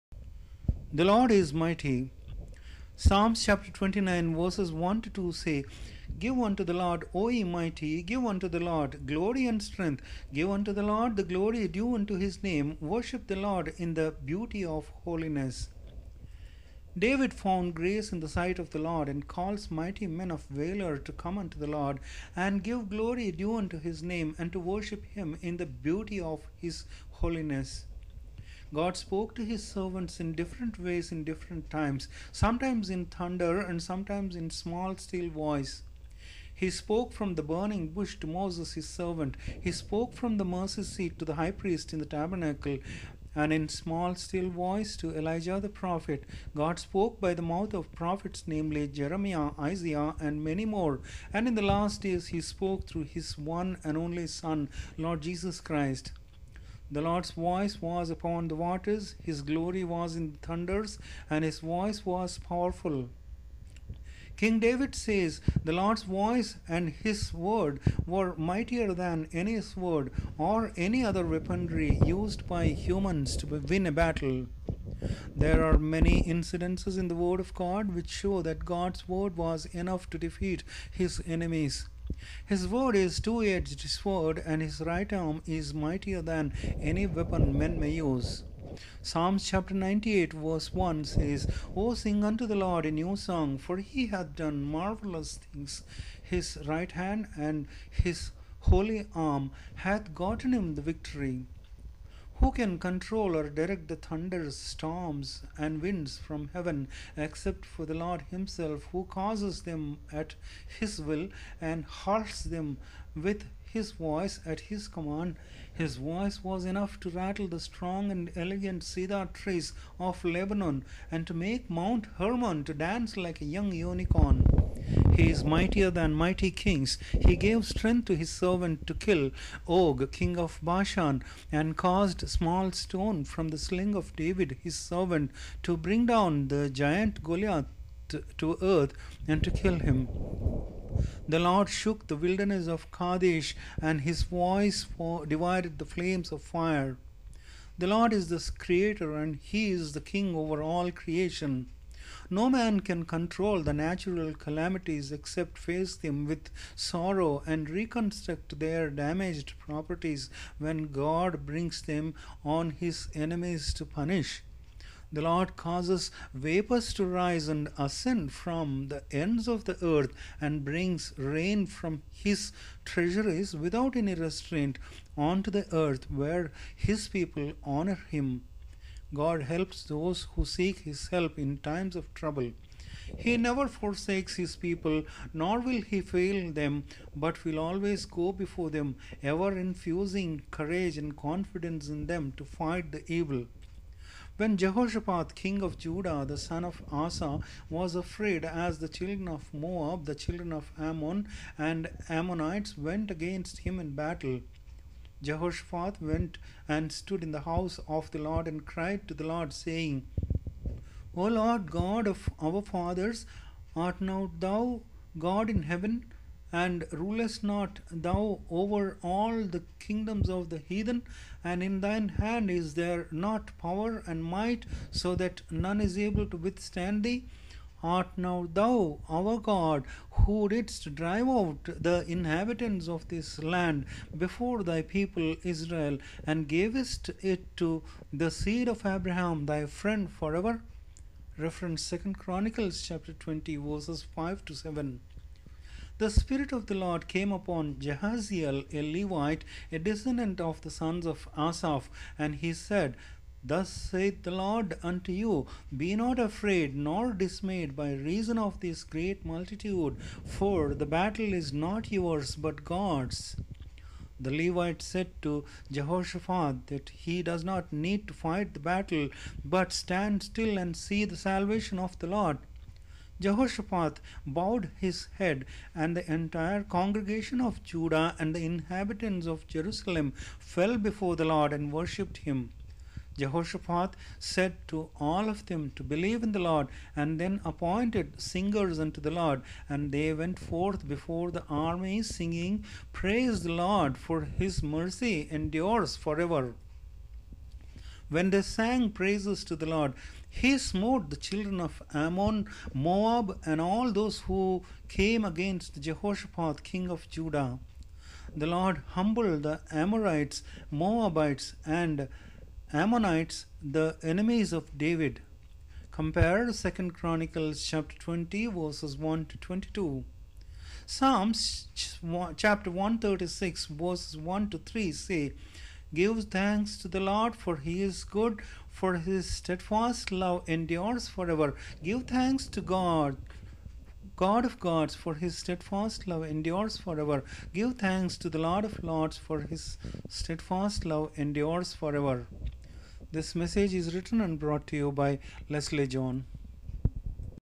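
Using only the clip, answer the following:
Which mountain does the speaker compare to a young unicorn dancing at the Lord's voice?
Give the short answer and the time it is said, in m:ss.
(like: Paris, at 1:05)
Mount Hermon, at 2:02.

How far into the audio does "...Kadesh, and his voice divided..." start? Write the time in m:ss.
2:22.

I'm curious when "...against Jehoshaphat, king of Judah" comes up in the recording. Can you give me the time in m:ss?
5:05.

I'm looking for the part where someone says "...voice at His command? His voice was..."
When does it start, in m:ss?
1:53.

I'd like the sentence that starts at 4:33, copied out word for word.
Jehoshaphat bowed his head, and the entire congregation of Judah and the inhabitants of Jerusalem fell before the Lord and worshipped him.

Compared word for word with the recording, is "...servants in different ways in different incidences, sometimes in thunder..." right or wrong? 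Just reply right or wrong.
wrong.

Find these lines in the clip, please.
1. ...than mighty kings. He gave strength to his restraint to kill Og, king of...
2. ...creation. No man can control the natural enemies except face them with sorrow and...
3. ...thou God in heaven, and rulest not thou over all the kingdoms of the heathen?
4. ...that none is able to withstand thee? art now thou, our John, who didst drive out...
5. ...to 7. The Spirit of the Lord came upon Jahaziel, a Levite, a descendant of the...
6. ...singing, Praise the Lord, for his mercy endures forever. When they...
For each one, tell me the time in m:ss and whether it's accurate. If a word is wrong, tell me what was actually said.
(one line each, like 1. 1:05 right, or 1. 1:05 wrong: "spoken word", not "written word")
1. 2:05 wrong: "servant", not "restraint"
2. 2:30 wrong: "calamities", not "enemies"
3. 3:34 right
4. 3:45 wrong: "God", not "John"
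5. 4:04 right
6. 4:52 right.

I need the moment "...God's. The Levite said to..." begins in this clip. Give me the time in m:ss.
4:22.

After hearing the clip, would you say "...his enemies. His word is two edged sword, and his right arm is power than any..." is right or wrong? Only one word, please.
wrong.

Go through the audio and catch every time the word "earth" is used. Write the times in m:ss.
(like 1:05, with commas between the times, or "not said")
2:18, 2:49, 2:55.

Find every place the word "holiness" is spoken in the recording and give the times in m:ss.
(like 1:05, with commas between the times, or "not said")
0:15, 0:27.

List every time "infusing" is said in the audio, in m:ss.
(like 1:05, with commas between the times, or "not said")
3:09.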